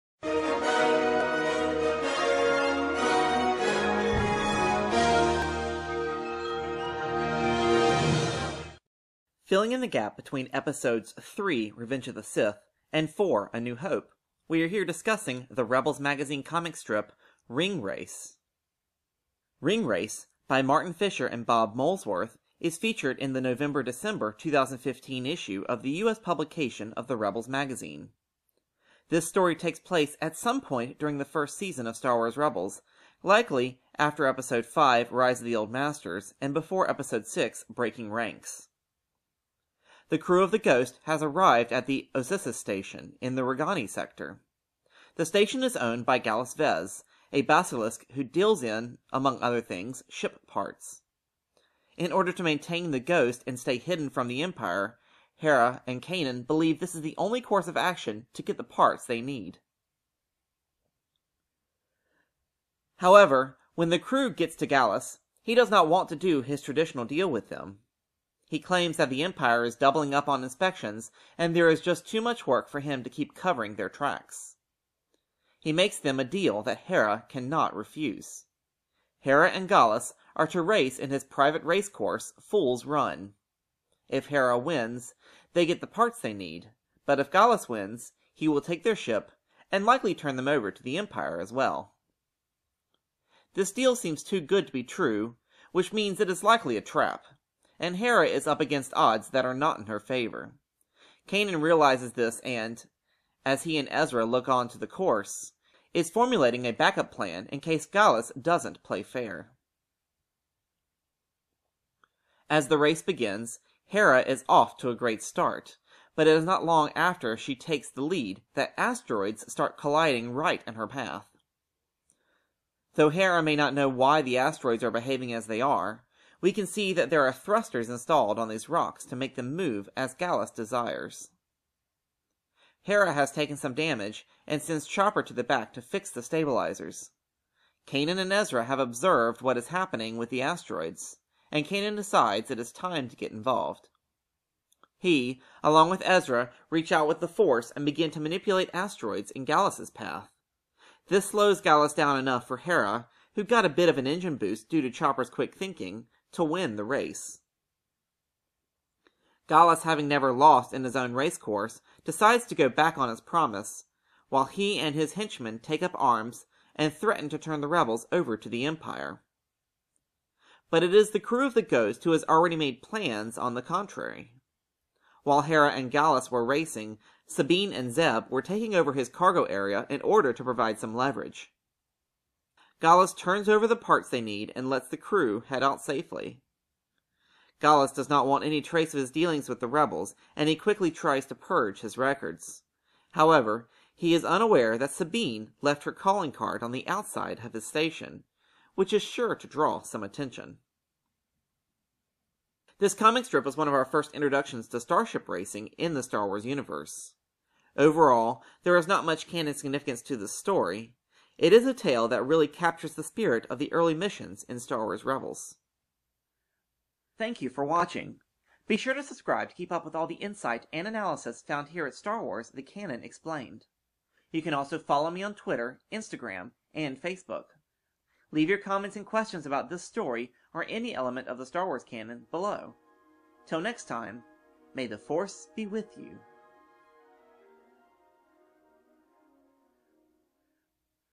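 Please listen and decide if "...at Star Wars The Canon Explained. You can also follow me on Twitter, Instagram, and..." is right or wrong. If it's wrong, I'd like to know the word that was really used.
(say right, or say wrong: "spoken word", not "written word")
right.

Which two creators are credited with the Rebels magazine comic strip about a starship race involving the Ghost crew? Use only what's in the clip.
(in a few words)
Martin Fisher and Bob Molesworth.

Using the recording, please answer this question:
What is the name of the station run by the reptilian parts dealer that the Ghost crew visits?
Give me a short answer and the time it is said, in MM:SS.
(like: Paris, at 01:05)
Ossissis station, at 00:42.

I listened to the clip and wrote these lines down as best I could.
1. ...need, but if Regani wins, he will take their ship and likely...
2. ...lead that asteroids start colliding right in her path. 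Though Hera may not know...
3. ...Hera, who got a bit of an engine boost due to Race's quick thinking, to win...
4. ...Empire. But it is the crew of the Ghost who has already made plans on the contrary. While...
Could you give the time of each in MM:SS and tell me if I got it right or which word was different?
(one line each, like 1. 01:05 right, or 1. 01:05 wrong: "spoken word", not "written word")
1. 01:26 wrong: "Gallus", not "Regani"
2. 01:58 right
3. 02:32 wrong: "Chopper", not "Race"
4. 02:48 right.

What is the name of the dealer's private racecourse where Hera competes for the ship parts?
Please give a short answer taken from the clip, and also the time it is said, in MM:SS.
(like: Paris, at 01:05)
Fool's Run, at 01:22.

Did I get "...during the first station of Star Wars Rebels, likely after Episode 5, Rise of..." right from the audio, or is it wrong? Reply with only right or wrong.
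wrong.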